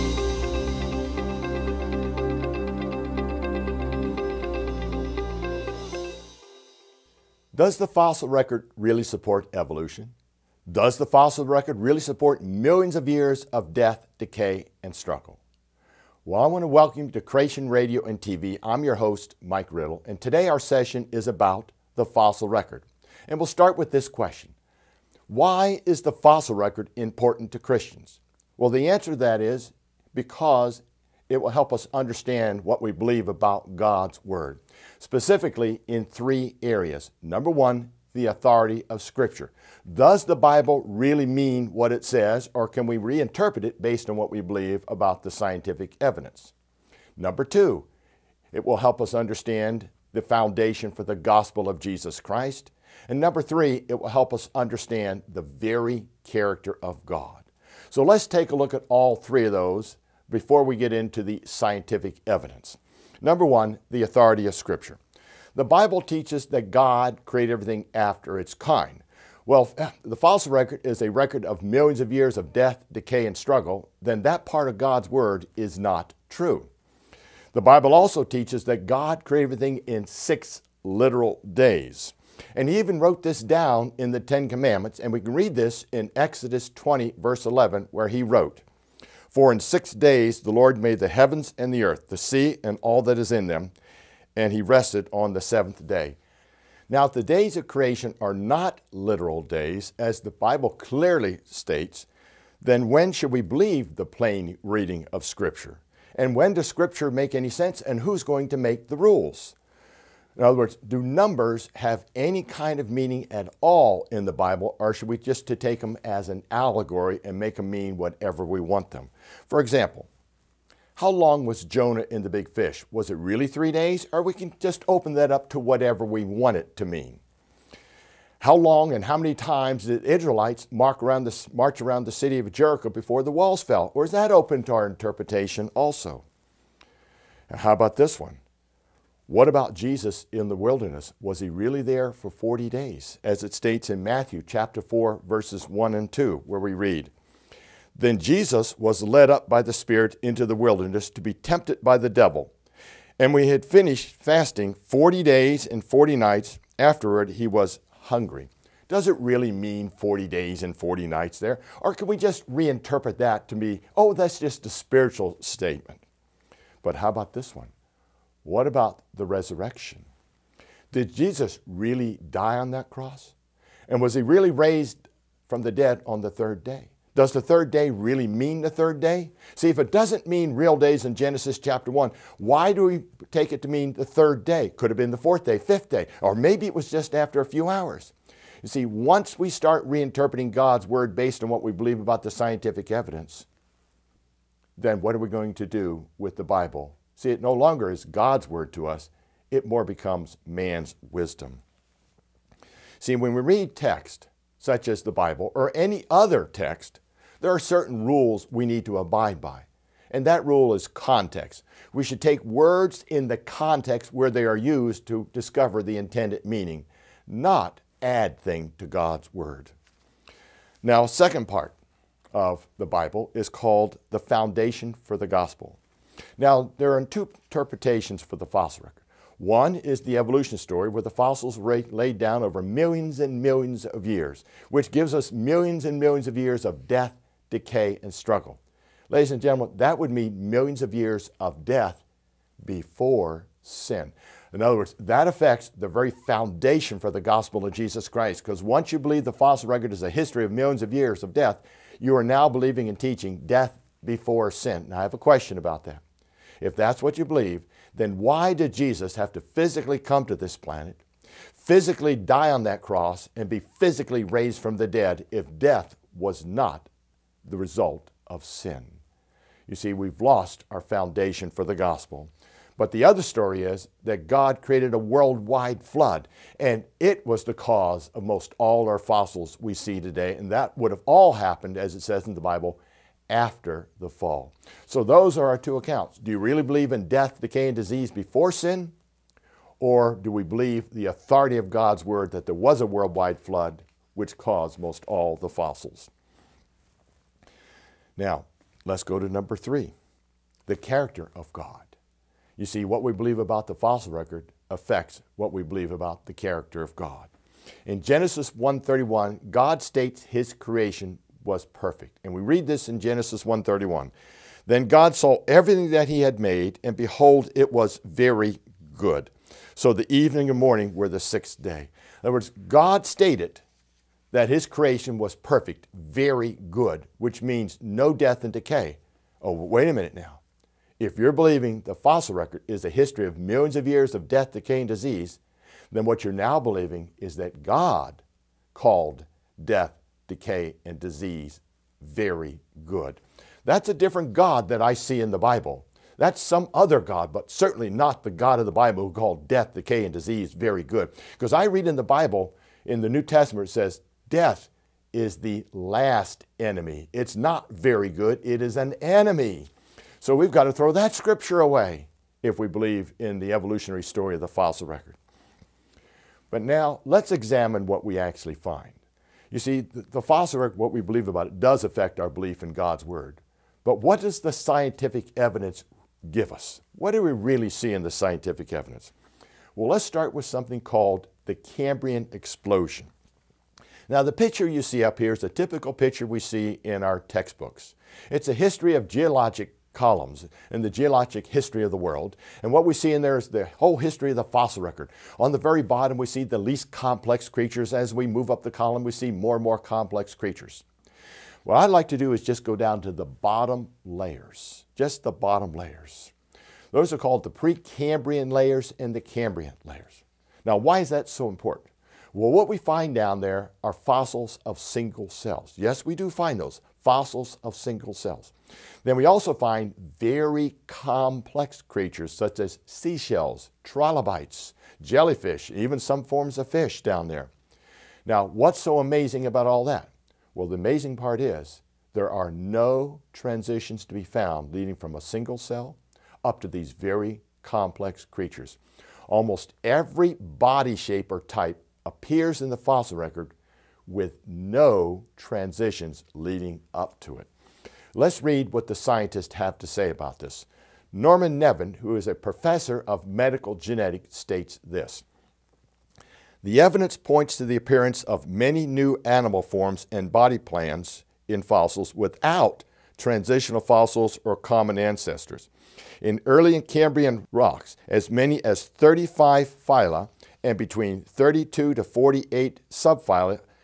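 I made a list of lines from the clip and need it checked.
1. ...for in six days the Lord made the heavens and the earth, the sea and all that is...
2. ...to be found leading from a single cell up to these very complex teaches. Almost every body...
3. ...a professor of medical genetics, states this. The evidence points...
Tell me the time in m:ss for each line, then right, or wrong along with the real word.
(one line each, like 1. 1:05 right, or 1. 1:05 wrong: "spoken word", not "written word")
1. 1:29 right
2. 7:14 wrong: "creatures", not "teaches"
3. 7:32 right.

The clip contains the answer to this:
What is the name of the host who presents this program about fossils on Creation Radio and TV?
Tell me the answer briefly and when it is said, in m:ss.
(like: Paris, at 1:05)
Mike Riddle, at 0:19.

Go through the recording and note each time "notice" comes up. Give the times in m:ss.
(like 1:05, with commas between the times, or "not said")
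not said.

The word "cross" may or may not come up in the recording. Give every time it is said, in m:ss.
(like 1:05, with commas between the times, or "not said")
2:52, 4:22.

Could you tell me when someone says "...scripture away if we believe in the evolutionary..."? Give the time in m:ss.
6:01.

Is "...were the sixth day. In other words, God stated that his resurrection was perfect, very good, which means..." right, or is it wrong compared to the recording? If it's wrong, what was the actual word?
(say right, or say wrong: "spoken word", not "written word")
wrong: "creation", not "resurrection".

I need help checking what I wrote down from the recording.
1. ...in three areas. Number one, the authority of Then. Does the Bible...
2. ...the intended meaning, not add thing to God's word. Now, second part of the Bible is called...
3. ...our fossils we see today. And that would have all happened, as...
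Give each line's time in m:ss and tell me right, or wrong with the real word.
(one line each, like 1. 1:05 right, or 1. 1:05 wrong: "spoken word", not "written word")
1. 0:35 wrong: "Scripture", not "Then"
2. 3:35 right
3. 4:38 right.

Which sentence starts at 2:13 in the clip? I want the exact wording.
Or is that open to our interpretation also?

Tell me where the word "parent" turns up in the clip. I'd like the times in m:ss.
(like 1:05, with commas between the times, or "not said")
not said.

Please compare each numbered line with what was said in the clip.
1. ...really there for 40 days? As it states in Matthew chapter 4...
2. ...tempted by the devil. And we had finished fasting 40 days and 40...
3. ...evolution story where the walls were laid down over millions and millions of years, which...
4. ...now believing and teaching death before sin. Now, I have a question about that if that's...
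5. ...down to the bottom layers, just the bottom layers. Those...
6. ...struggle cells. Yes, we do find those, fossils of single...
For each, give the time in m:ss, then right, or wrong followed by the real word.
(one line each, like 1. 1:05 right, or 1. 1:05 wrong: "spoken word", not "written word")
1. 2:21 right
2. 2:31 right
3. 3:50 wrong: "fossils", not "walls"
4. 4:12 right
5. 6:42 right
6. 6:54 wrong: "single", not "struggle".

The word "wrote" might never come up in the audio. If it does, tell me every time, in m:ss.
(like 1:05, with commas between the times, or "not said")
1:23, 1:28.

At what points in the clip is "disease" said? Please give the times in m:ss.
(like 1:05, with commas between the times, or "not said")
4:47, 5:34, 5:40, 5:50.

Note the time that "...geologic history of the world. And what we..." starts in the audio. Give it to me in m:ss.
6:30.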